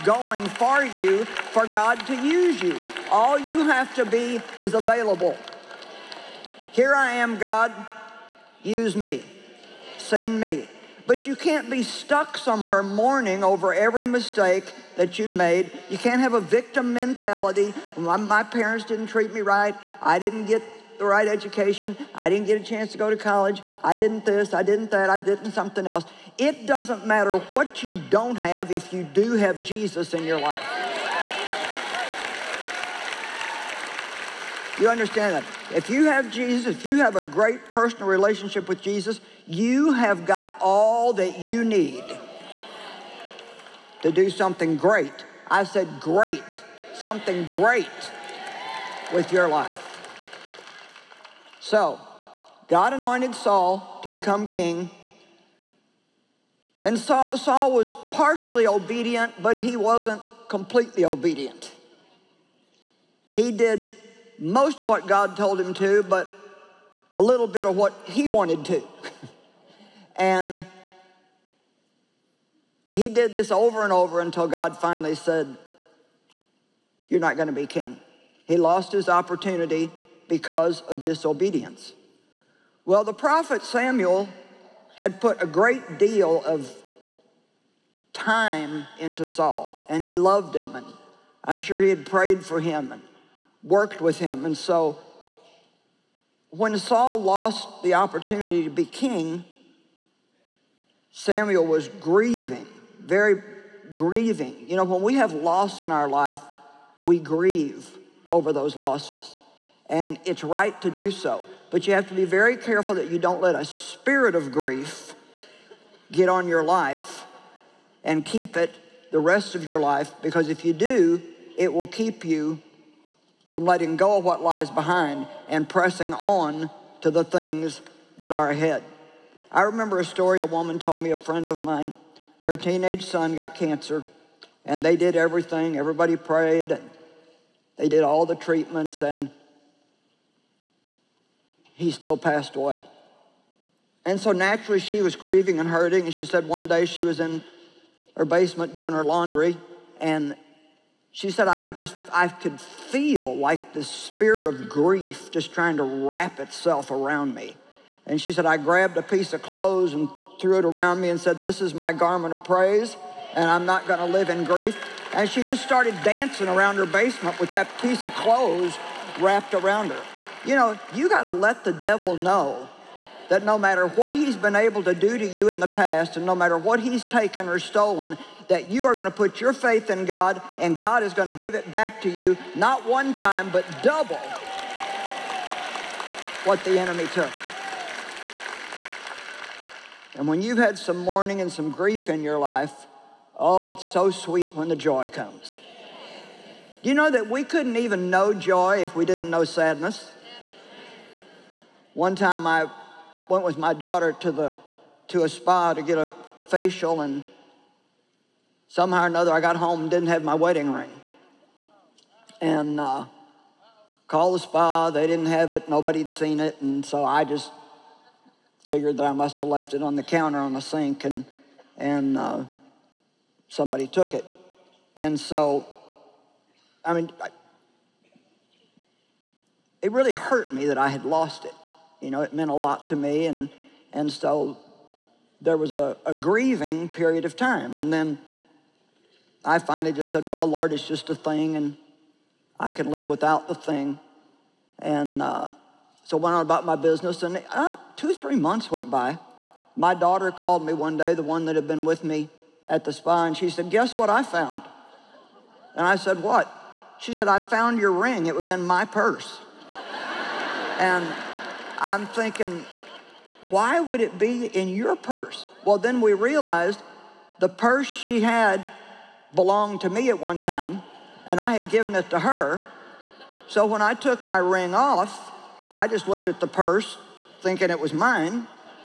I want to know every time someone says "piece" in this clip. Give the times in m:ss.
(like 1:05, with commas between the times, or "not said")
2:39, 2:47.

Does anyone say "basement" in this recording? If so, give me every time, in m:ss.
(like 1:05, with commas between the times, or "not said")
2:28, 2:46.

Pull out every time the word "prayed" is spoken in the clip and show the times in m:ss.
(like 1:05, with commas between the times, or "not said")
1:32, 2:16.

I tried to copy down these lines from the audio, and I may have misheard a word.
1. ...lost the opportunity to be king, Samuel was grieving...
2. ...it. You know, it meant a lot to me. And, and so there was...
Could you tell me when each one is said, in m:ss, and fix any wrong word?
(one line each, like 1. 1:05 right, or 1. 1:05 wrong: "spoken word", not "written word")
1. 1:37 right
2. 3:51 right.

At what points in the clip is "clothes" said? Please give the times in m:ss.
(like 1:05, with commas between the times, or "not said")
2:39, 2:48.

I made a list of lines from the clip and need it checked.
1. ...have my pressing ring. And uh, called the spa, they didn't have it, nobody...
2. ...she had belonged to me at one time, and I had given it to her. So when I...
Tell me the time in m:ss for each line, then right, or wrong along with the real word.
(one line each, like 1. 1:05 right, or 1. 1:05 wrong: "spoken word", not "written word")
1. 3:30 wrong: "wedding", not "pressing"
2. 4:27 right.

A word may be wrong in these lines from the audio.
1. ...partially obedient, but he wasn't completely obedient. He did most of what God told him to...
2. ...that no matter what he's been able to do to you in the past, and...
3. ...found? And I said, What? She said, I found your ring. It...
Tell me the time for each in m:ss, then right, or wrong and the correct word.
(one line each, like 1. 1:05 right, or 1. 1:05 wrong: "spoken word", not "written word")
1. 0:58 right
2. 2:53 right
3. 4:14 right.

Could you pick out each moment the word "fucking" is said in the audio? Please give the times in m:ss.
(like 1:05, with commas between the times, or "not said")
not said.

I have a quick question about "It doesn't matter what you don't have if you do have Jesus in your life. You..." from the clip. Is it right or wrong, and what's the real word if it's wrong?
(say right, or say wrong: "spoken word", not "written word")
right.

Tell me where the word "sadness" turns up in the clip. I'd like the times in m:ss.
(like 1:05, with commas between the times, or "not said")
3:19.